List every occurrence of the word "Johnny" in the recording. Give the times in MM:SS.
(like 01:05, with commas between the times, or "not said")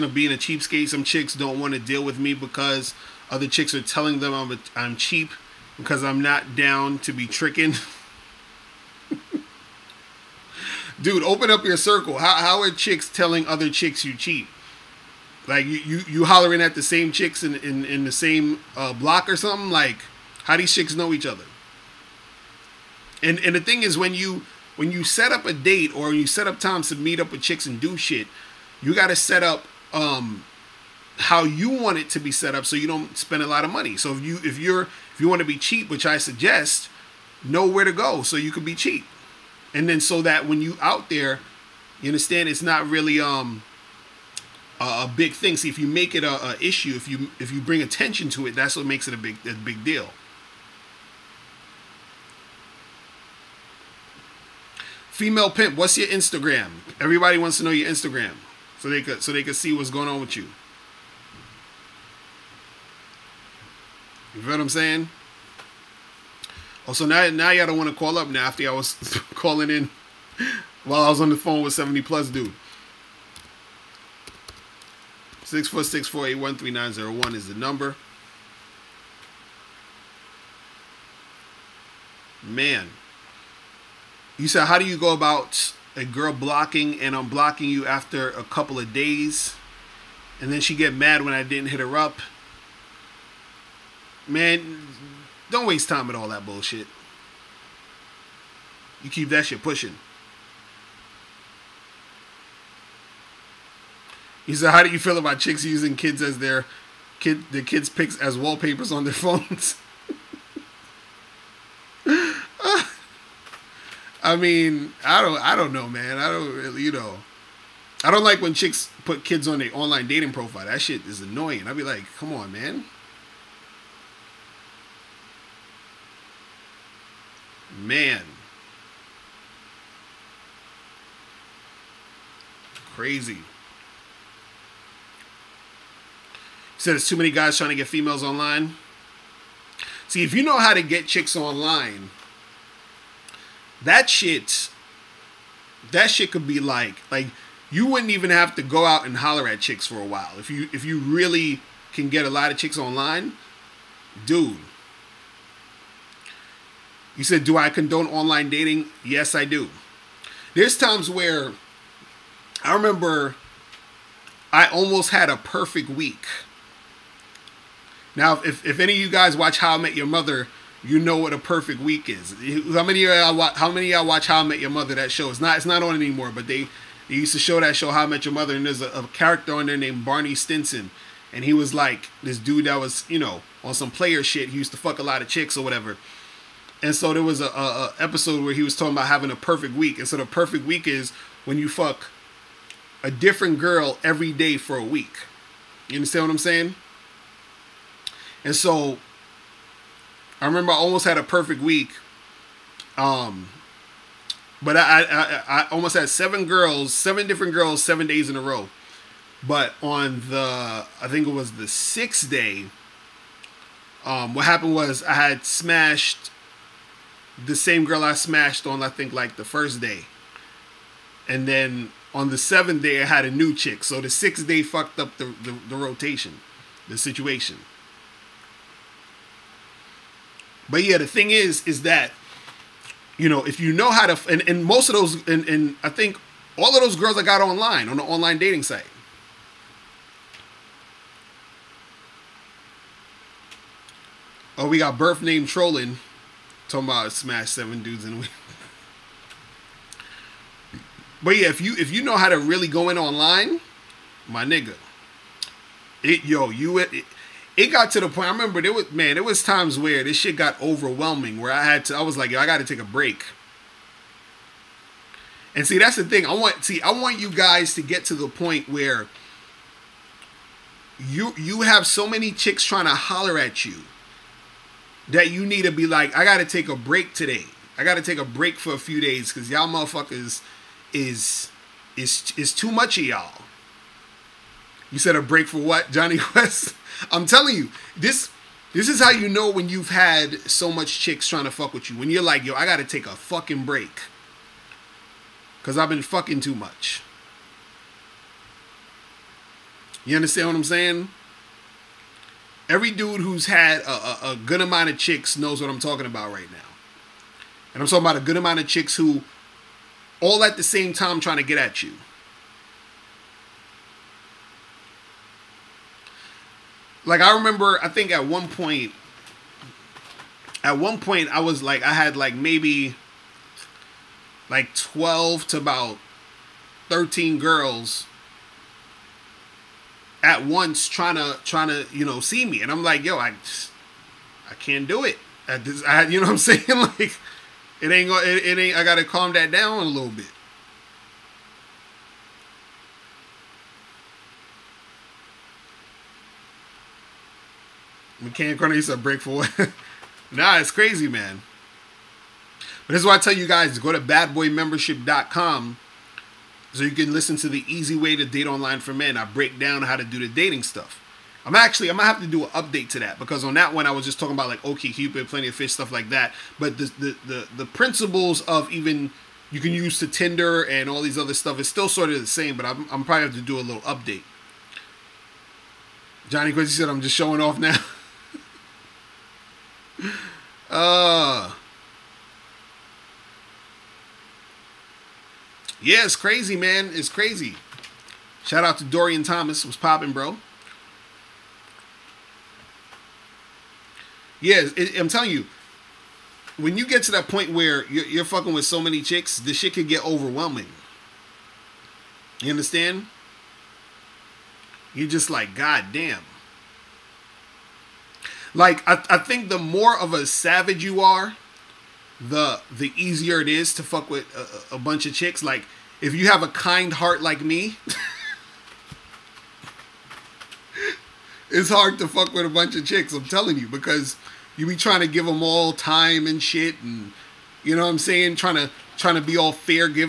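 04:45, 06:16.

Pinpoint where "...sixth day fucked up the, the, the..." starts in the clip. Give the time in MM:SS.
03:44.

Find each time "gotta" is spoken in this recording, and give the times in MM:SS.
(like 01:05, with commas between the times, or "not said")
04:52, 05:38.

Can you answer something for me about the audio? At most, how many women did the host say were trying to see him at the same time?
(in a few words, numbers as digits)
13.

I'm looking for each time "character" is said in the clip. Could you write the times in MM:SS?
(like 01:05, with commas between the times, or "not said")
02:59.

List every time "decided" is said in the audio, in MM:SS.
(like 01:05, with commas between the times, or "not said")
not said.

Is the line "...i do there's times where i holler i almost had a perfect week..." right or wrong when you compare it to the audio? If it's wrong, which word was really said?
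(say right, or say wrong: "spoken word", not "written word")
wrong: "remember", not "holler".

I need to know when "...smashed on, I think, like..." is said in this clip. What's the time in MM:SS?
03:38.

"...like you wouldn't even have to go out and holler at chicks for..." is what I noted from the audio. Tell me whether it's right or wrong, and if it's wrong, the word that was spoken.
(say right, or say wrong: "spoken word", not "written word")
right.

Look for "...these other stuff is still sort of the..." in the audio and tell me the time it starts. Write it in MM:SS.
06:11.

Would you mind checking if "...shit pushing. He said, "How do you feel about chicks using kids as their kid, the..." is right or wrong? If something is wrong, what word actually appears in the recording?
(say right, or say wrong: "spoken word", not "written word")
right.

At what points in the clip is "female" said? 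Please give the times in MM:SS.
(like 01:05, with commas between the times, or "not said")
00:55, 02:17.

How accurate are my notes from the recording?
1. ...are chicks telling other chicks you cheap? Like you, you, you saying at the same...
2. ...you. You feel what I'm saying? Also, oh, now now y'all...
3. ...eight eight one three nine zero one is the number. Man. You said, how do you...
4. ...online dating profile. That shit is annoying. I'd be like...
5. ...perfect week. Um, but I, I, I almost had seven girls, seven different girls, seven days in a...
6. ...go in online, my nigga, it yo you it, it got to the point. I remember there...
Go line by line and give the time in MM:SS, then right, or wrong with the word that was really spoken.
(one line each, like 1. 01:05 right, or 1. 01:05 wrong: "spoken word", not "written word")
1. 00:12 wrong: "hollering", not "saying"
2. 01:00 right
3. 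01:16 wrong: "four", not "eight"
4. 01:59 right
5. 03:21 right
6. 04:12 right.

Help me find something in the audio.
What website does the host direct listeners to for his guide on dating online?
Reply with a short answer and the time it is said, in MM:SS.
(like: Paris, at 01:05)
badboymembership.com, at 05:53.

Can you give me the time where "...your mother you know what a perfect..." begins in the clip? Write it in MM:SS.
02:49.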